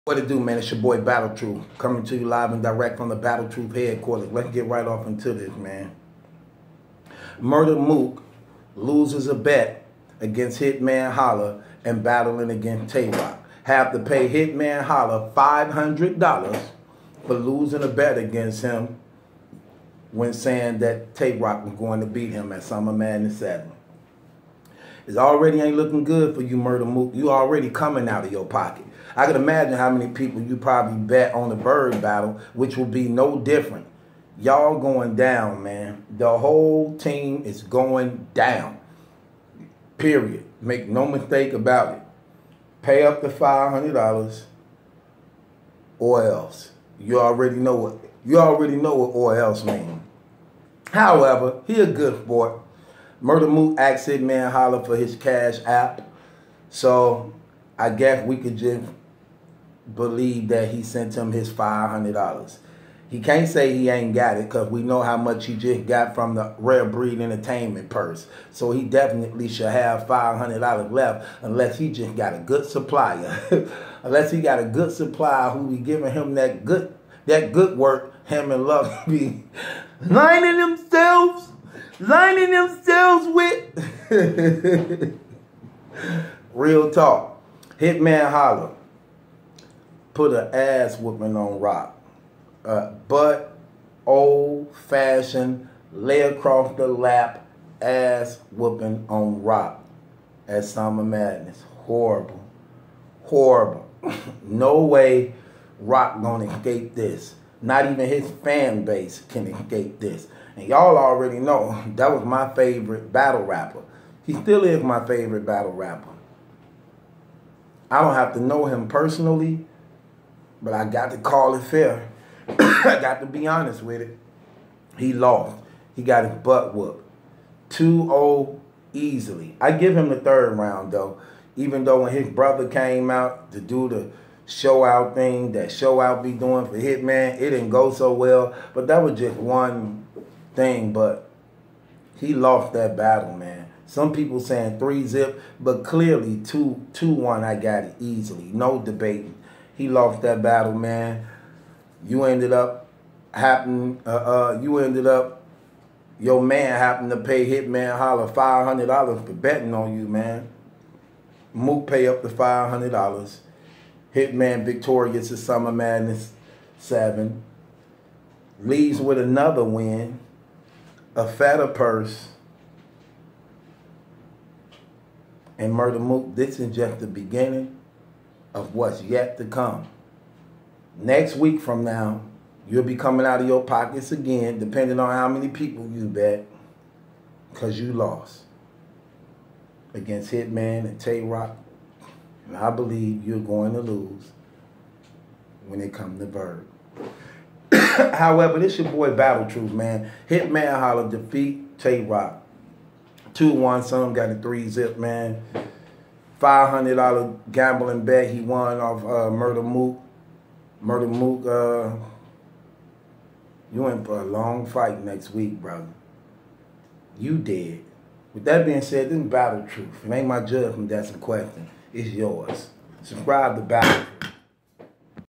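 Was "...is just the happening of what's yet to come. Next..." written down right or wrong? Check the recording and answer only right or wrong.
wrong.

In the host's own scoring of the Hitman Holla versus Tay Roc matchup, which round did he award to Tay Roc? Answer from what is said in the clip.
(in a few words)
third round.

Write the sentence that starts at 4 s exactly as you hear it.
Let's get right off into this, man.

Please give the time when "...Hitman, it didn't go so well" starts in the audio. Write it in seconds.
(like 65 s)
136 s.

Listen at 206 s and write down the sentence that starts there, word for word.
$500 gambling bet he won off uh, Murda Mook.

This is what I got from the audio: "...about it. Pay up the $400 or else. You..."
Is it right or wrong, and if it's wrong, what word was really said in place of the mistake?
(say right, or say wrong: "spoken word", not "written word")
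wrong: "500", not "400".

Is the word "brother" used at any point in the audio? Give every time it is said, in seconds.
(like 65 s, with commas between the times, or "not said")
132 s, 215 s.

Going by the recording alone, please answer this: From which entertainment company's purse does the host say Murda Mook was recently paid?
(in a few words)
Rare Breed Entertainment.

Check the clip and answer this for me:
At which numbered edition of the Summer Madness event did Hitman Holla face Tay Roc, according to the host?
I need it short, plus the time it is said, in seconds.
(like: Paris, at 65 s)
Summer Madness 7, at 22 s.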